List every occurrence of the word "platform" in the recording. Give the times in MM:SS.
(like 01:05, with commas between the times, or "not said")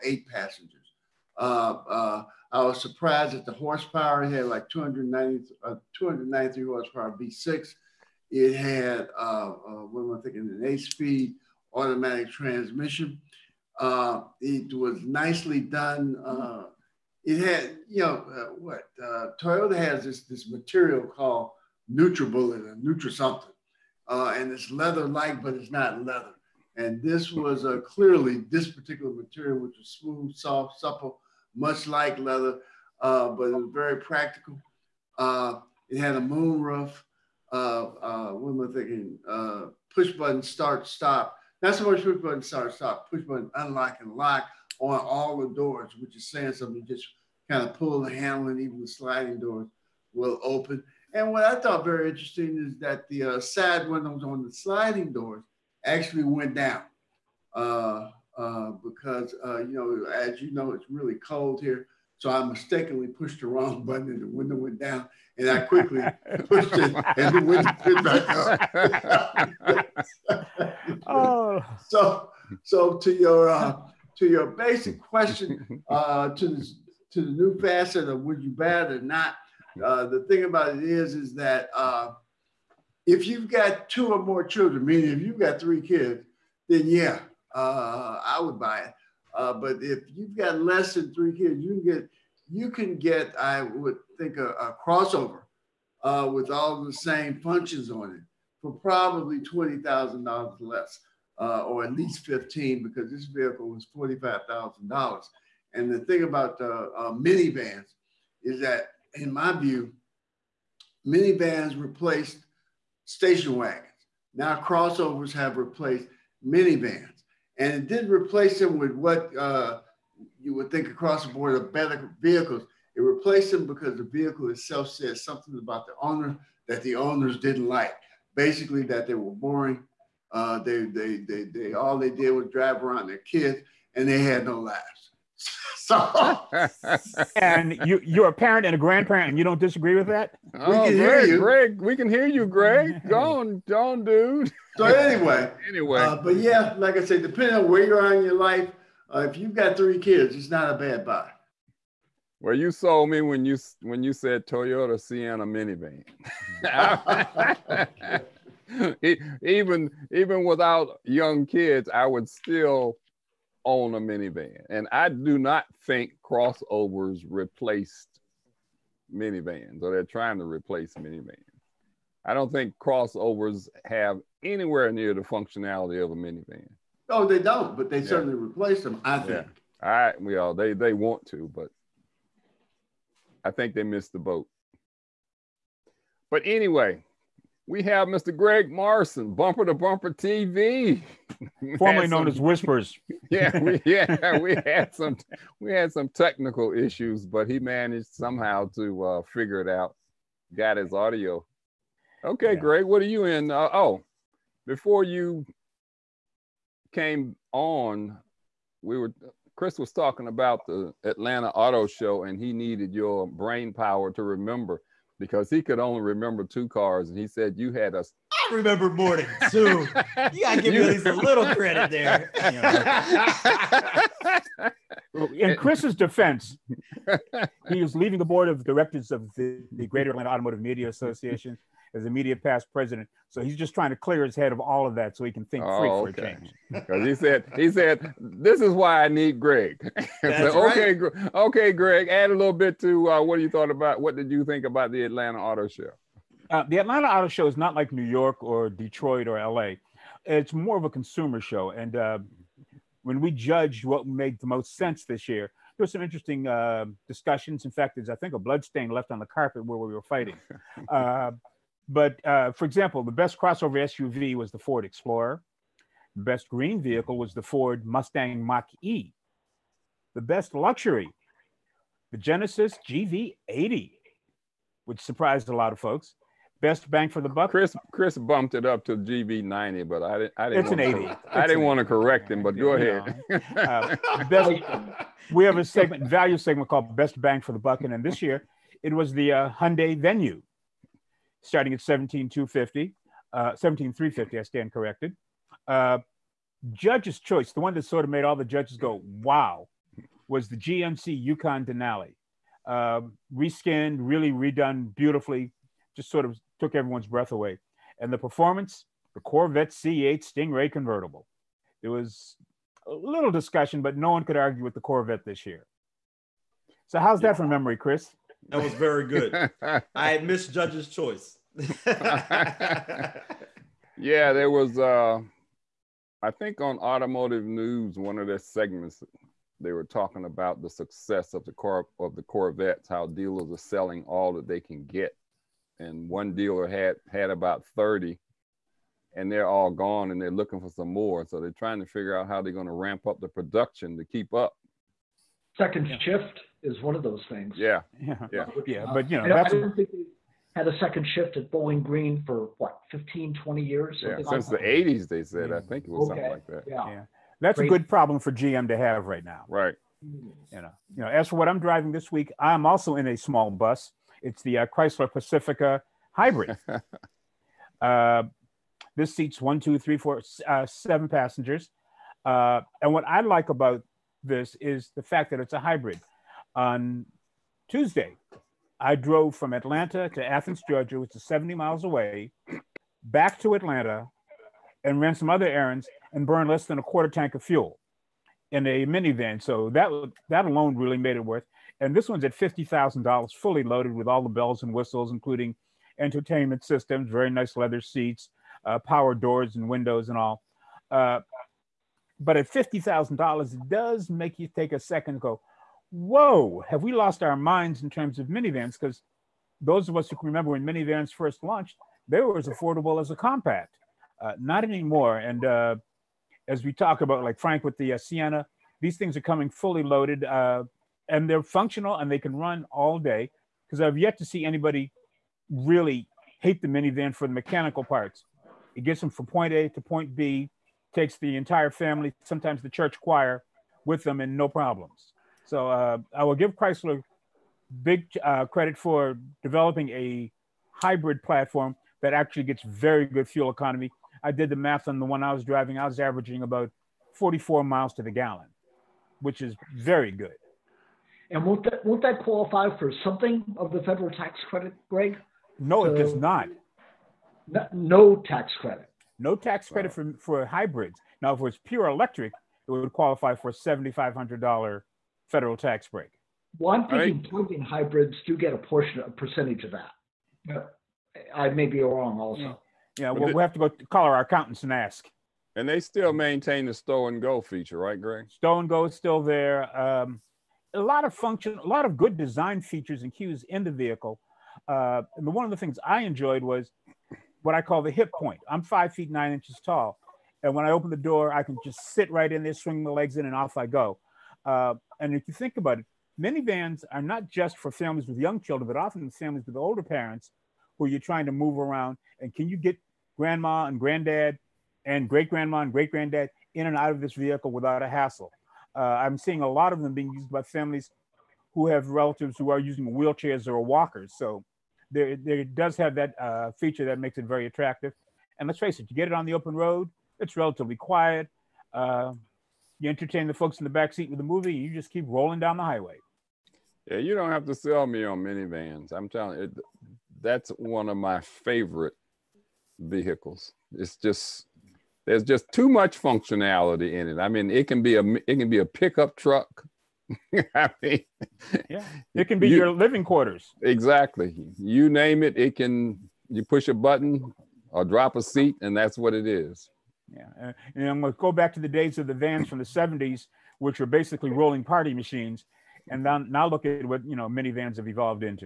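07:21.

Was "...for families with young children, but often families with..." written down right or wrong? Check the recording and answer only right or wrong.
right.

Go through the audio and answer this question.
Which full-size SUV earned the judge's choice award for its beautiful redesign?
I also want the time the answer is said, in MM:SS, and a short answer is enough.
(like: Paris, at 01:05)
GMC Yukon Denali, at 05:00.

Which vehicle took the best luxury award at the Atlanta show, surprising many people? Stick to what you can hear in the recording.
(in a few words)
Genesis GV80.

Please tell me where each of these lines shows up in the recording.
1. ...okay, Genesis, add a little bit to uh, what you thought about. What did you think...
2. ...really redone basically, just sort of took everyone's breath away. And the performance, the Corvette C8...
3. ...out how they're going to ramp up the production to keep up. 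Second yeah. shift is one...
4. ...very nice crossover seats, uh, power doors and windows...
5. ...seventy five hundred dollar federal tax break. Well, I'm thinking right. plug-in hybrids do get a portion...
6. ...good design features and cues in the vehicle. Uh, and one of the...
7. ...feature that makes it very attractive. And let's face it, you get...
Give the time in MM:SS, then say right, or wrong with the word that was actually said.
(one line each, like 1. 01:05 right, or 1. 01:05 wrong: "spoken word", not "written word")
1. 04:01 wrong: "Greg", not "Genesis"
2. 05:04 wrong: "beautifully", not "basically"
3. 05:42 right
4. 06:37 wrong: "leather", not "crossover"
5. 07:43 right
6. 08:01 right
7. 08:36 right.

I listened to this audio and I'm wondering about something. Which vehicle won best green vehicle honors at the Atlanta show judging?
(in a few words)
Ford Mustang Mach E.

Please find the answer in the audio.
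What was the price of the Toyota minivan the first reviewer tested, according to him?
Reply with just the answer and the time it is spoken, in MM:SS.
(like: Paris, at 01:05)
$45,000, at 01:43.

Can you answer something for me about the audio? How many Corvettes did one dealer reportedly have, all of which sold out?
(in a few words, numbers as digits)
30.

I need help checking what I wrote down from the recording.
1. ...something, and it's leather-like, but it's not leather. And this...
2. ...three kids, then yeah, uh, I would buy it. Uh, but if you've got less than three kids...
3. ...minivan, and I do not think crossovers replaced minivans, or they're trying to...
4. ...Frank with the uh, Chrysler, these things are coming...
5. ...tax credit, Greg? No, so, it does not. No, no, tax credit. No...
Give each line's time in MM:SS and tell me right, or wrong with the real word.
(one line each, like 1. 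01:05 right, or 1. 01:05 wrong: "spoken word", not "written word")
1. 00:23 right
2. 01:25 right
3. 02:44 right
4. 06:57 wrong: "Sienna", not "Chrysler"
5. 07:34 right.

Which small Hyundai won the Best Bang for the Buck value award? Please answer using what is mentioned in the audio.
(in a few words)
Hyundai Venue.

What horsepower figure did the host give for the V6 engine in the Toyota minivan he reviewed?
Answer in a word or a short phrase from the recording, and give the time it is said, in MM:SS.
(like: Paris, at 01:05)
293, at 00:05.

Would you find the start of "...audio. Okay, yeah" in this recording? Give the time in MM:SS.
03:20.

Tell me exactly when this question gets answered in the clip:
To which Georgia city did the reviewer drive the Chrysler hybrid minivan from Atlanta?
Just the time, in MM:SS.
06:20.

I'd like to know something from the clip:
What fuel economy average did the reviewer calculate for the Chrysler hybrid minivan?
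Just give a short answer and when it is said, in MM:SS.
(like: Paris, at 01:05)
44 mpg, at 07:27.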